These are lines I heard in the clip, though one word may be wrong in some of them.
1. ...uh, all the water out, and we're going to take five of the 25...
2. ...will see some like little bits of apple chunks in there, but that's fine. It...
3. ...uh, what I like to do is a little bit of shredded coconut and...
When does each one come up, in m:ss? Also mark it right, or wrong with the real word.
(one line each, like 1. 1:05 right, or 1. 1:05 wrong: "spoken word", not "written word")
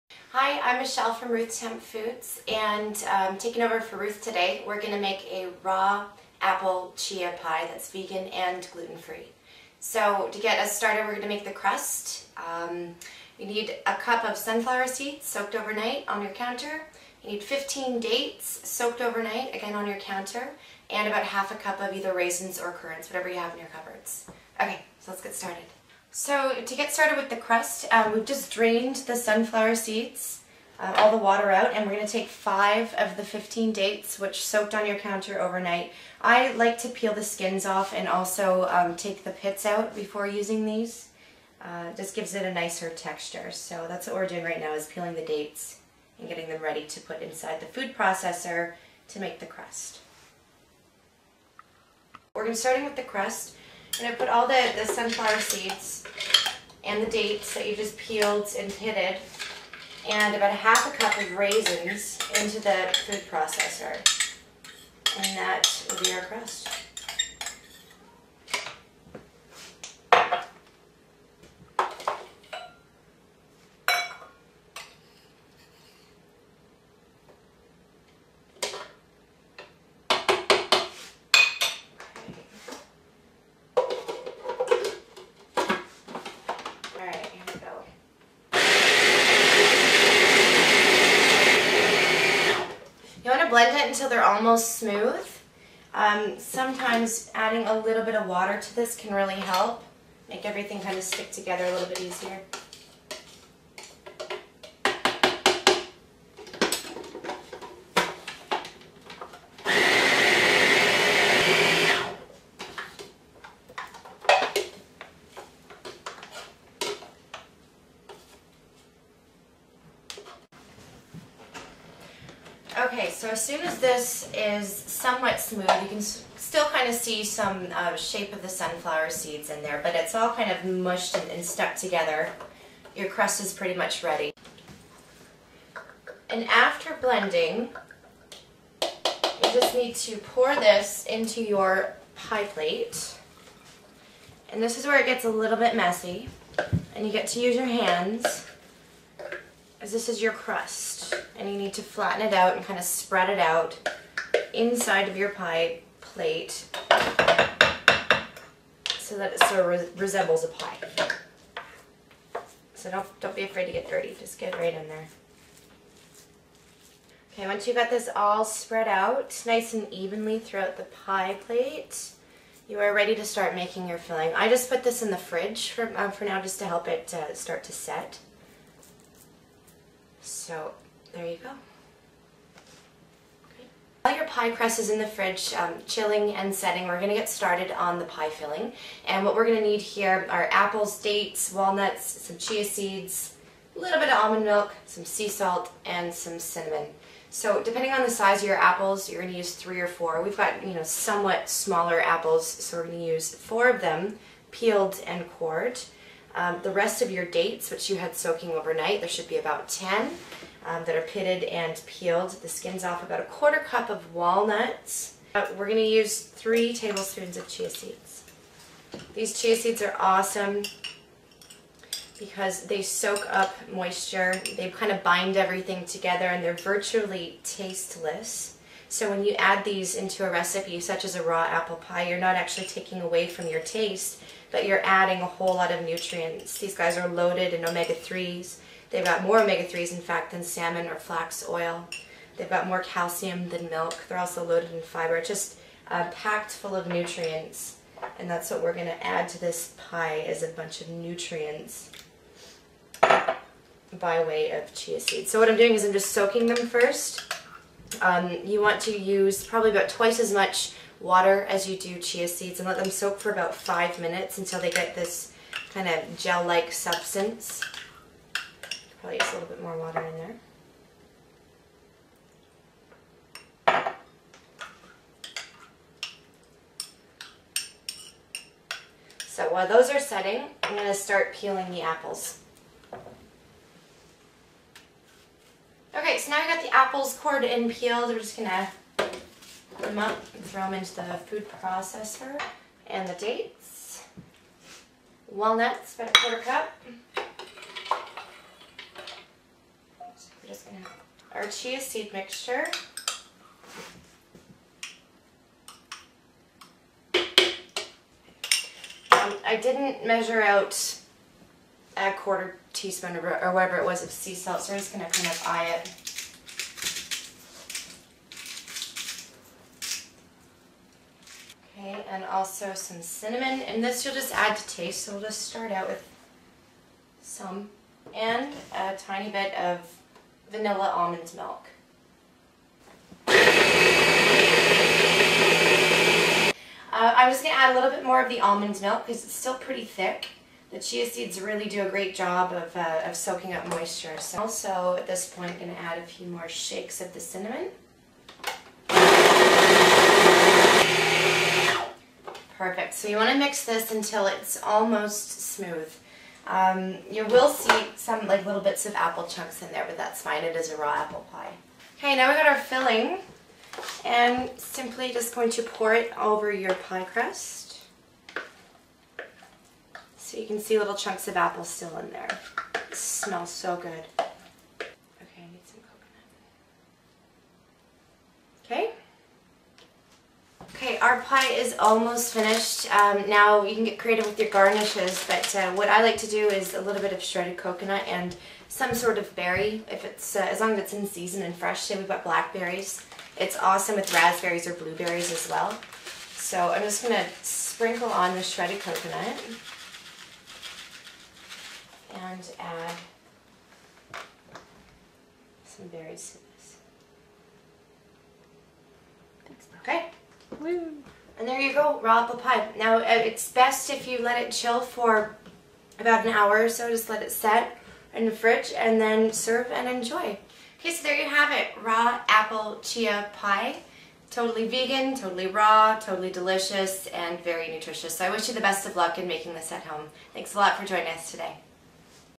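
1. 0:30 wrong: "15", not "25"
2. 5:57 right
3. 6:25 right.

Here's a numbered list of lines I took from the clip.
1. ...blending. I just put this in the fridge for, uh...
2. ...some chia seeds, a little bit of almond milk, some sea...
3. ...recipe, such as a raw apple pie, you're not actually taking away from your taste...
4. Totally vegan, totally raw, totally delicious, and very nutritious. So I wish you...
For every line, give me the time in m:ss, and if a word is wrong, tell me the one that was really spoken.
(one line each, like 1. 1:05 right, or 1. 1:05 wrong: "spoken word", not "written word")
1. 2:53 wrong: "filling", not "blending"
2. 3:12 right
3. 3:50 right
4. 7:04 right.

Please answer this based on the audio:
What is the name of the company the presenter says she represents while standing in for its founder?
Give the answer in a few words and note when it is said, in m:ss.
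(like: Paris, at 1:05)
Ruth's Hemp Foods, at 0:01.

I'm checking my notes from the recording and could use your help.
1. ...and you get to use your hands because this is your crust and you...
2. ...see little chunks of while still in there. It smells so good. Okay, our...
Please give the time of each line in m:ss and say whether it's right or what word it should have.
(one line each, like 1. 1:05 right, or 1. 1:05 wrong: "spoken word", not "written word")
1. 2:26 right
2. 6:10 wrong: "apple", not "while".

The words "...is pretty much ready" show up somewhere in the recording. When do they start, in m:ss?
2:13.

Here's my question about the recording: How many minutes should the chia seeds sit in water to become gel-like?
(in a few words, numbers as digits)
5.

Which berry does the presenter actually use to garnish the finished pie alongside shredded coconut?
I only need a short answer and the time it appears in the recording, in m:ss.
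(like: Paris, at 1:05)
blackberries, at 6:32.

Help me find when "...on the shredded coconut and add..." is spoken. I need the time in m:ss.
6:38.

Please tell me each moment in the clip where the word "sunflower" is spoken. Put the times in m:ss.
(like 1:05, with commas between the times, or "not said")
0:14, 0:29, 0:54, 2:08.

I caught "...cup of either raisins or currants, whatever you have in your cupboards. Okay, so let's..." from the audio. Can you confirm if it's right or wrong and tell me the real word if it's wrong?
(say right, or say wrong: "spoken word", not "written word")
right.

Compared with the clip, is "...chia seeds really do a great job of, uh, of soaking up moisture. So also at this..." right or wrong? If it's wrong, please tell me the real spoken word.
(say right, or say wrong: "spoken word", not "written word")
right.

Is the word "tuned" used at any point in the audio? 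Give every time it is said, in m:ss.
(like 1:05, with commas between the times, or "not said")
not said.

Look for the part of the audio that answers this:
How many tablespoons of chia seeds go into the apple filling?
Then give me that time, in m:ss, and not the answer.
3:36.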